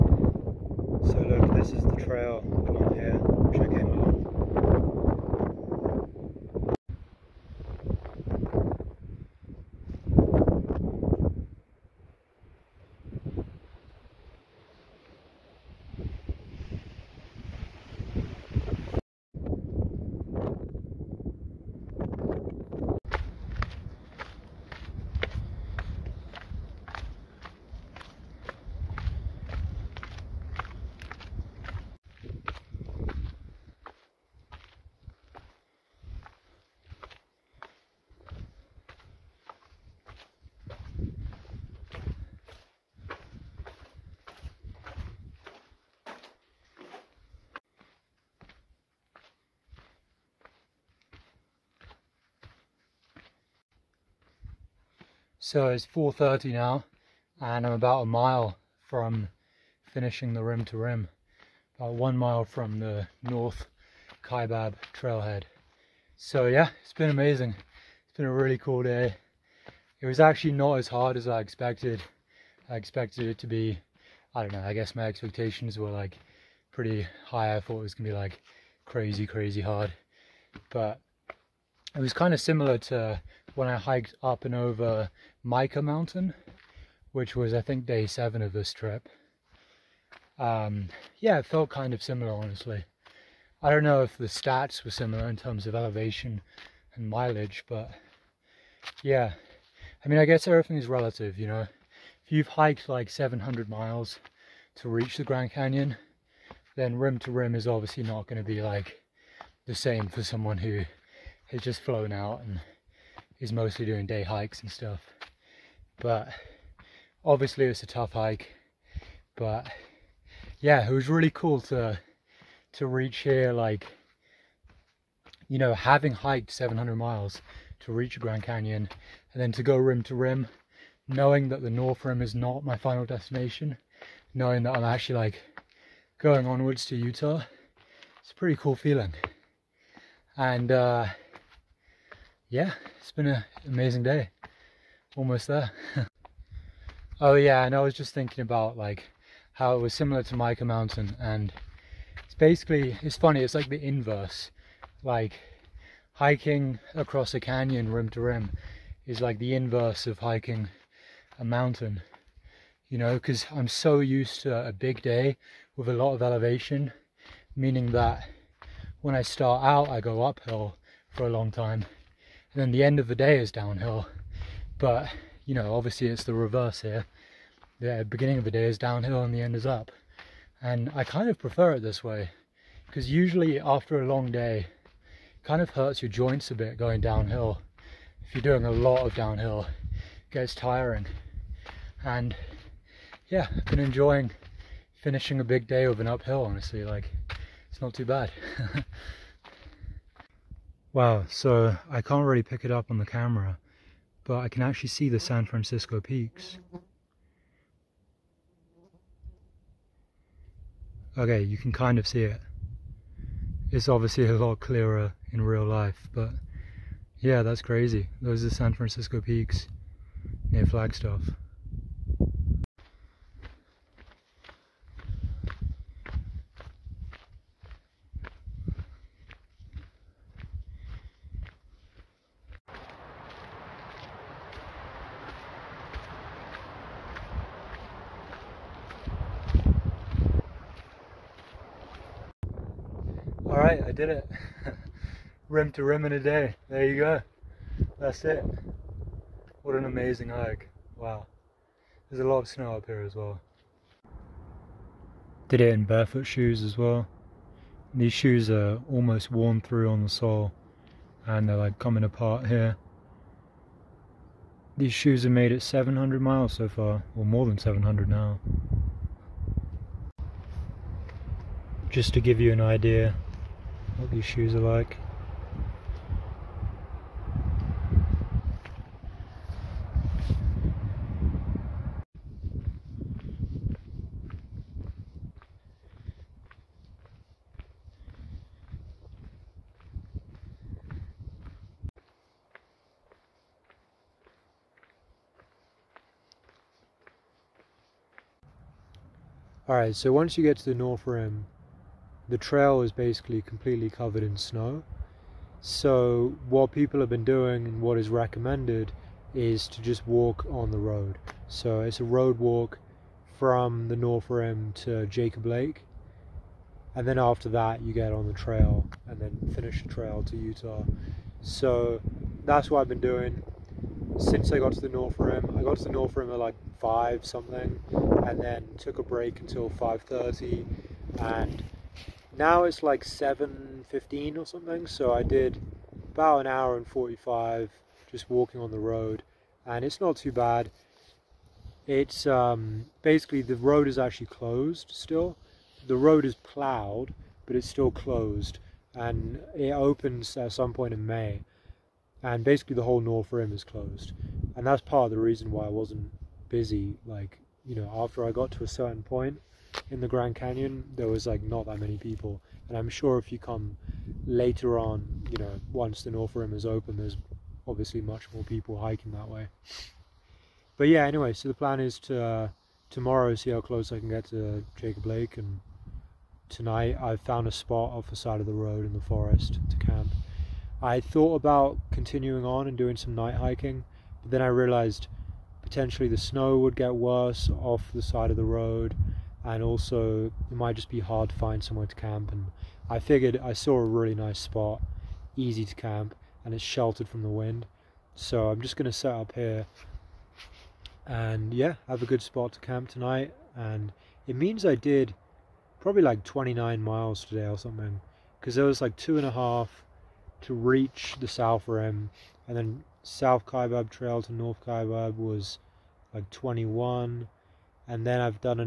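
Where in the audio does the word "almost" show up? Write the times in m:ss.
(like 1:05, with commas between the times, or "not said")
2:25, 4:18.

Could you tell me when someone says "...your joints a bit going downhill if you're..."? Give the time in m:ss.
3:06.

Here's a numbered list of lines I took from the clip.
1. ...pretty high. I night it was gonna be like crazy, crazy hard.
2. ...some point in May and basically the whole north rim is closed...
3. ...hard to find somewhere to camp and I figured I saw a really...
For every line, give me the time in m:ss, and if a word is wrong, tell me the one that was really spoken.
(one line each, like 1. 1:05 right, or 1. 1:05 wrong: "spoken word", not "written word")
1. 1:16 wrong: "thought", not "night"
2. 5:50 right
3. 6:30 right.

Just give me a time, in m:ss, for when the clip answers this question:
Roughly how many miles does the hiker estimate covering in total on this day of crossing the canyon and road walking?
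6:46.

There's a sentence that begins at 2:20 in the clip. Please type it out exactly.
And uh, yeah, it's been an amazing day.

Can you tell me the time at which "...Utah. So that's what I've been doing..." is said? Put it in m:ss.
5:20.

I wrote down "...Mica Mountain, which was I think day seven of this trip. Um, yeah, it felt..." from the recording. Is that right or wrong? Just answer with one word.
right.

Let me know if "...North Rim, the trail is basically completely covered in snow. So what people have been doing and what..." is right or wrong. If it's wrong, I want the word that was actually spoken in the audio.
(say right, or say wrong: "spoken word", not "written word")
right.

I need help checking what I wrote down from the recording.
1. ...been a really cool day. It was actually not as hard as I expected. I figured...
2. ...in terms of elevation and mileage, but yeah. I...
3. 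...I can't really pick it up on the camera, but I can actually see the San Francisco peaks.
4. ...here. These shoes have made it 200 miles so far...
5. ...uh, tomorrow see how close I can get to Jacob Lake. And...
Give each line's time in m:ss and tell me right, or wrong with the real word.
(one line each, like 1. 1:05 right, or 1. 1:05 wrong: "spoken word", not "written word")
1. 1:08 wrong: "expected", not "figured"
2. 1:35 right
3. 3:21 right
4. 4:22 wrong: "700", not "200"
5. 6:12 right.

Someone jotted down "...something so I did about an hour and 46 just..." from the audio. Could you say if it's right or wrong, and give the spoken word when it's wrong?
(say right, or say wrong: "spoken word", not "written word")
wrong: "45", not "46".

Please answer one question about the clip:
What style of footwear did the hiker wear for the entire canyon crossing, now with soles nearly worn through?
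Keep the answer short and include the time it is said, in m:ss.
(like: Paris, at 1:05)
barefoot shoes, at 4:15.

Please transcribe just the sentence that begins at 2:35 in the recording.
Like hiking across a canyon rim to rim is like the inverse of hiking a mountain.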